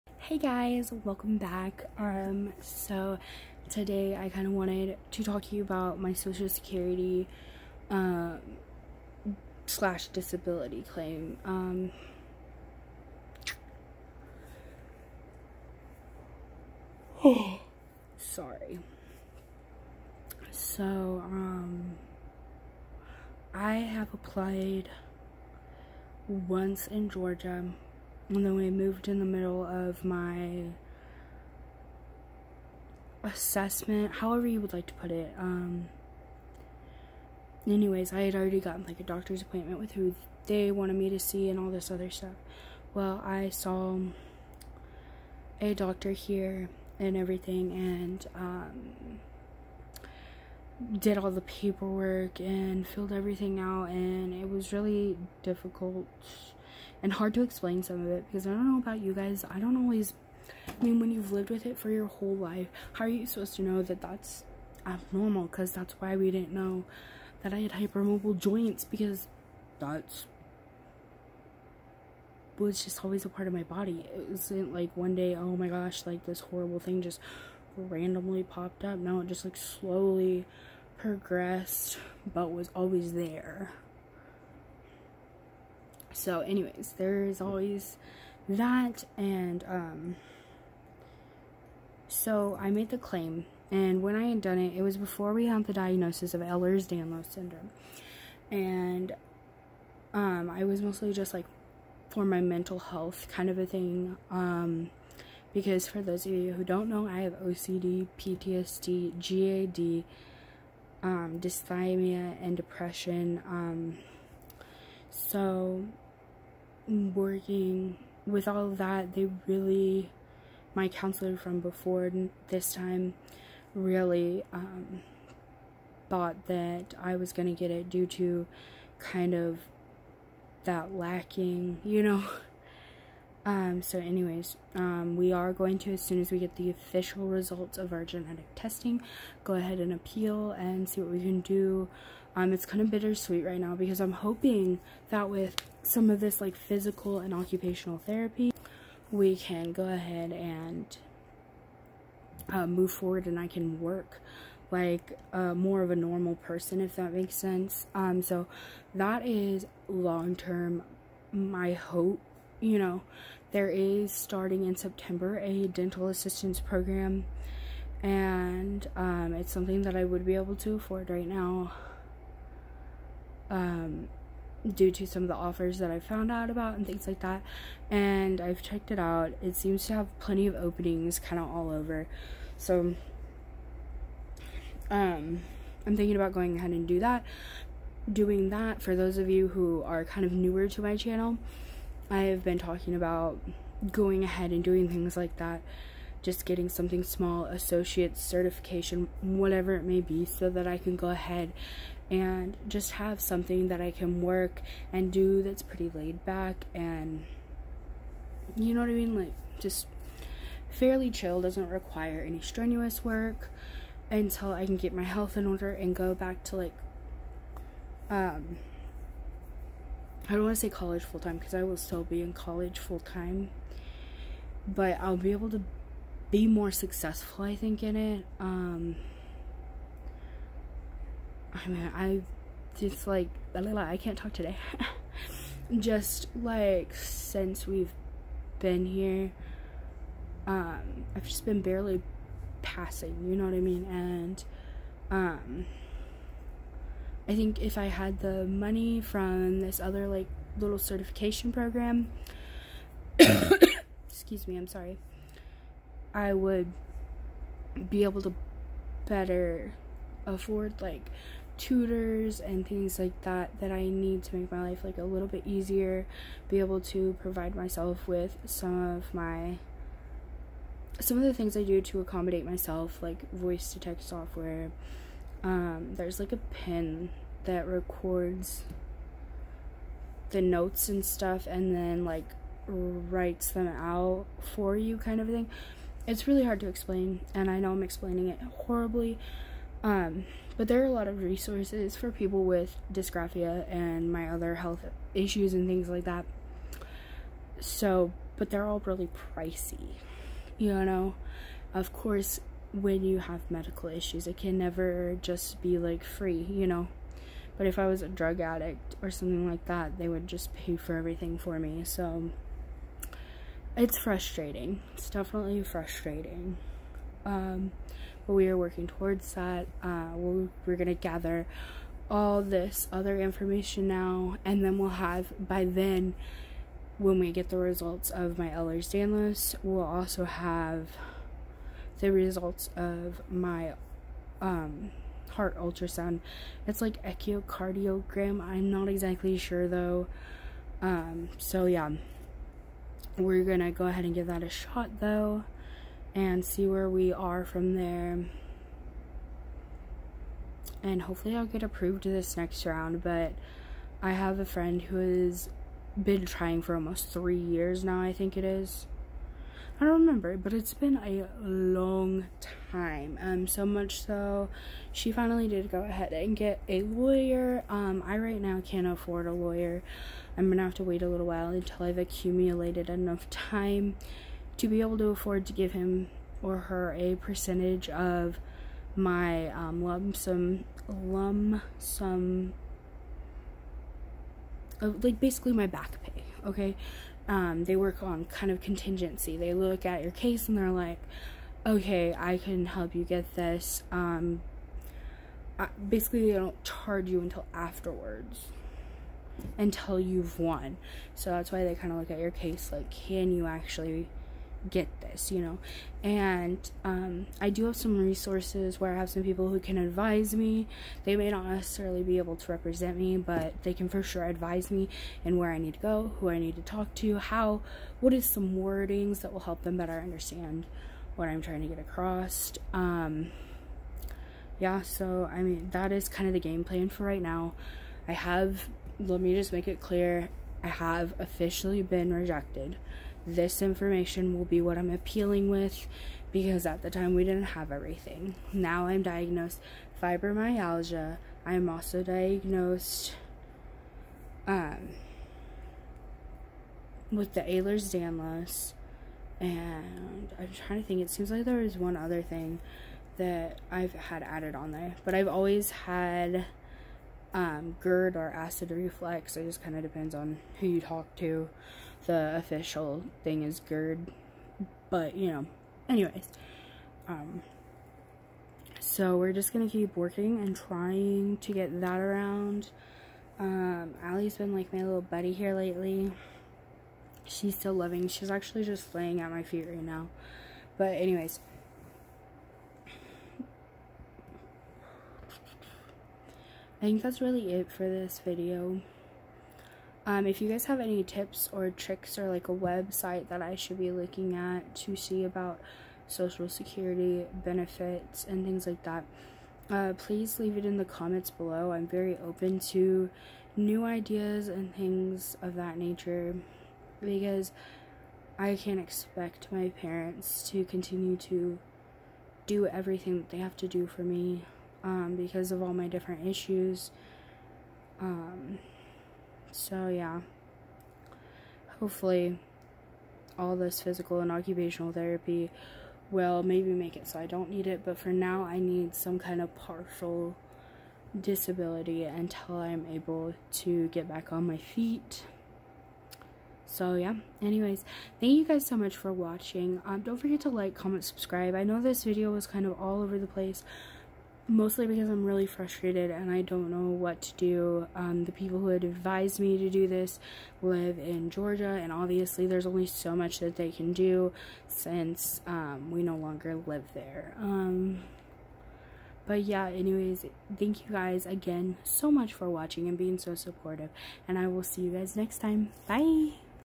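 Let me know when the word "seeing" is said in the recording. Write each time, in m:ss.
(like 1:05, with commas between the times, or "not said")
not said.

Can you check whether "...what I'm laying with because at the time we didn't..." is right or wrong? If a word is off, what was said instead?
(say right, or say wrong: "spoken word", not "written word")
wrong: "appealing", not "laying".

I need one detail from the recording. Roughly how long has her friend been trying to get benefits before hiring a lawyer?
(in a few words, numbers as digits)
Almost 3 years.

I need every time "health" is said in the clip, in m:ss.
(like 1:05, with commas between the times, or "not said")
1:42, 3:35, 4:54.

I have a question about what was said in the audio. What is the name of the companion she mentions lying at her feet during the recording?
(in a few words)
Allie.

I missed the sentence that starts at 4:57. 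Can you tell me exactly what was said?
So, but they're all really pricey, you know?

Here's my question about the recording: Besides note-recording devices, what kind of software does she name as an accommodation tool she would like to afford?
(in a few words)
Voice to text software.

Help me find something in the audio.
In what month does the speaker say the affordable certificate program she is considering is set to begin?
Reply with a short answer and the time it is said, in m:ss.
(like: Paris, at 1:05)
September, at 2:44.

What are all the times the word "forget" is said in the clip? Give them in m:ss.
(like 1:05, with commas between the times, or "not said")
9:00.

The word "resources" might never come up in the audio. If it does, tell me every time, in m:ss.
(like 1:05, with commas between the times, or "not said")
4:51, 6:47.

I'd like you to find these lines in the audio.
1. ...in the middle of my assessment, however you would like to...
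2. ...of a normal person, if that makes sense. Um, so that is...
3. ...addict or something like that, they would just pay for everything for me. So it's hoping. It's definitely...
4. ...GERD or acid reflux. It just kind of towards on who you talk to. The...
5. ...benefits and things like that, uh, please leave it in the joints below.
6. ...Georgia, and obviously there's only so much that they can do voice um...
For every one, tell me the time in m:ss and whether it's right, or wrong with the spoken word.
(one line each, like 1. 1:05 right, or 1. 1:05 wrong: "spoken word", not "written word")
1. 0:29 right
2. 2:35 right
3. 5:08 wrong: "frustrating", not "hoping"
4. 7:37 wrong: "depends", not "towards"
5. 8:17 wrong: "comments", not "joints"
6. 9:11 wrong: "since", not "voice".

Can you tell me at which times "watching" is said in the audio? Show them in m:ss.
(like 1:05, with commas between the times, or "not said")
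8:59, 9:22.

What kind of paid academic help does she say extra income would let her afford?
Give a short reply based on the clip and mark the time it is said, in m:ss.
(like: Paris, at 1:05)
Tutors, at 4:21.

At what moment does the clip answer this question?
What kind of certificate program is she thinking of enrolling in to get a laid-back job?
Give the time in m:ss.
2:45.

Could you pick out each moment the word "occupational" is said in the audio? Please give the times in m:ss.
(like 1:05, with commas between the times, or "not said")
2:27, 8:44.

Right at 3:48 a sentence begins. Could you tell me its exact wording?
Um, I mean, I just like, I can't talk today.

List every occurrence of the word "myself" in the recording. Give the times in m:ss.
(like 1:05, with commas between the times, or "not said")
4:27, 4:32.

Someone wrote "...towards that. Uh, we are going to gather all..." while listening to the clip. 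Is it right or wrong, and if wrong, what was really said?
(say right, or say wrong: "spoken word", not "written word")
right.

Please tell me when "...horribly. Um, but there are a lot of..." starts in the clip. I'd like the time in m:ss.
4:48.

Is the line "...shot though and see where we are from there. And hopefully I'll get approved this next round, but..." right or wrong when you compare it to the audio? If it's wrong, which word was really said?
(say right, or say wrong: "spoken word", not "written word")
right.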